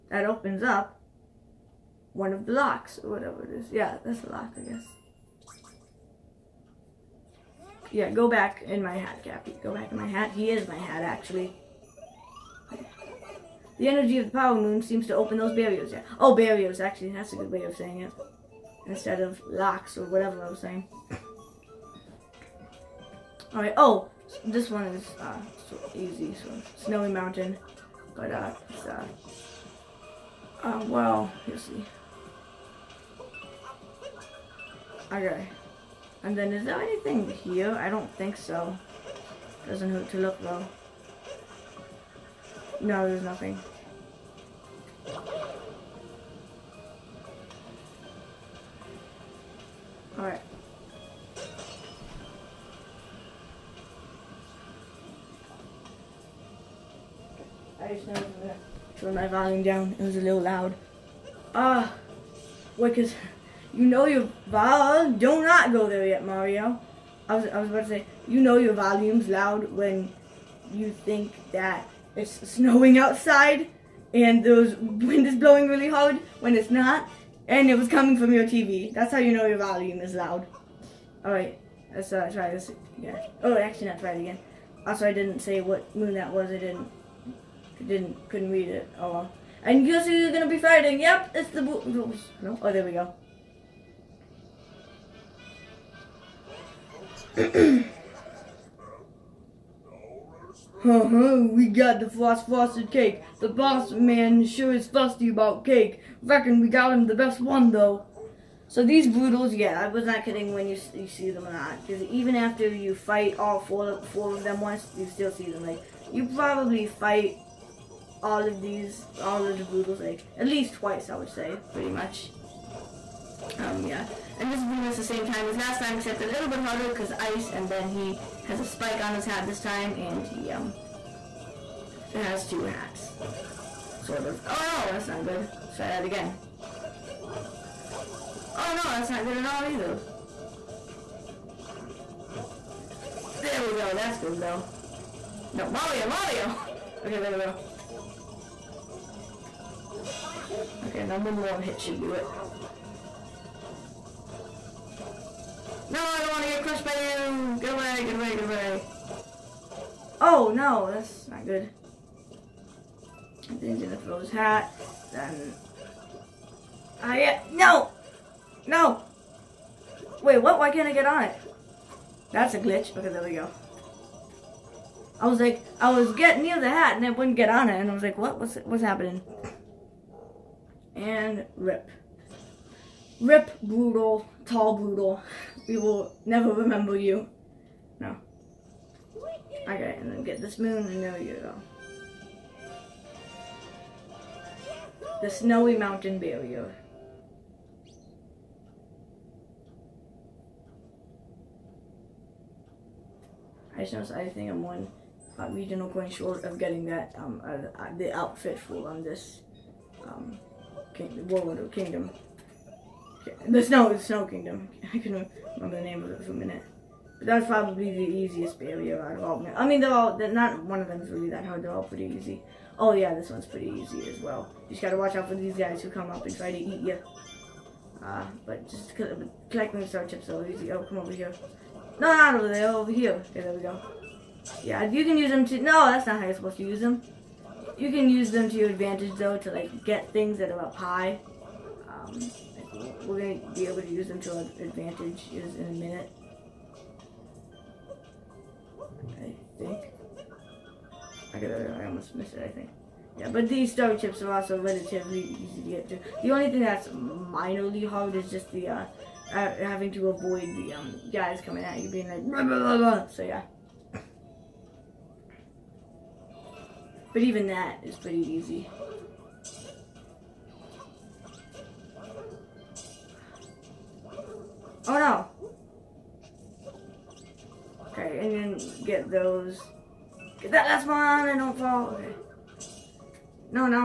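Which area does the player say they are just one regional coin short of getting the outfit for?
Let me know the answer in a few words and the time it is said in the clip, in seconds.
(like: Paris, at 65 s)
Snow Kingdom, at 213 s.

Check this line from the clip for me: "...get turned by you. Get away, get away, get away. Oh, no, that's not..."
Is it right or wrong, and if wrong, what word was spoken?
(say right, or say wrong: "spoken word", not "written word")
wrong: "crushed", not "turned".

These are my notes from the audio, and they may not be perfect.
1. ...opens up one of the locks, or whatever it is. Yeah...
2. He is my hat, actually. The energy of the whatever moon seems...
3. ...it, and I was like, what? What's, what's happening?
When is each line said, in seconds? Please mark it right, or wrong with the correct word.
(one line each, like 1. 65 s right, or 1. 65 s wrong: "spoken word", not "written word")
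1. 0 s right
2. 10 s wrong: "power", not "whatever"
3. 177 s right.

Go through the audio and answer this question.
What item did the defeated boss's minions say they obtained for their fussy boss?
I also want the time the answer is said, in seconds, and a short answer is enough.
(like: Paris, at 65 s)
frosted cake, at 102 s.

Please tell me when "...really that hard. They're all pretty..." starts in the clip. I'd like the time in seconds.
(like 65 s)
221 s.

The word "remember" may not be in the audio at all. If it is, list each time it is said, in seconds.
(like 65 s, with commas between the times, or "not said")
186 s, 215 s.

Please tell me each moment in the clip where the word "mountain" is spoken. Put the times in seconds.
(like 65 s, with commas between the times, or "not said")
27 s, 195 s.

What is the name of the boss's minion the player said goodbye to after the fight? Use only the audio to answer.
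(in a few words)
Tall Broodal.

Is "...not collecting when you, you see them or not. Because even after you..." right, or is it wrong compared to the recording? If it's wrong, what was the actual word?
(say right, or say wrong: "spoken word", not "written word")
wrong: "kidding", not "collecting".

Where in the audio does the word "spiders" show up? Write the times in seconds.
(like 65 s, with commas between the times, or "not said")
not said.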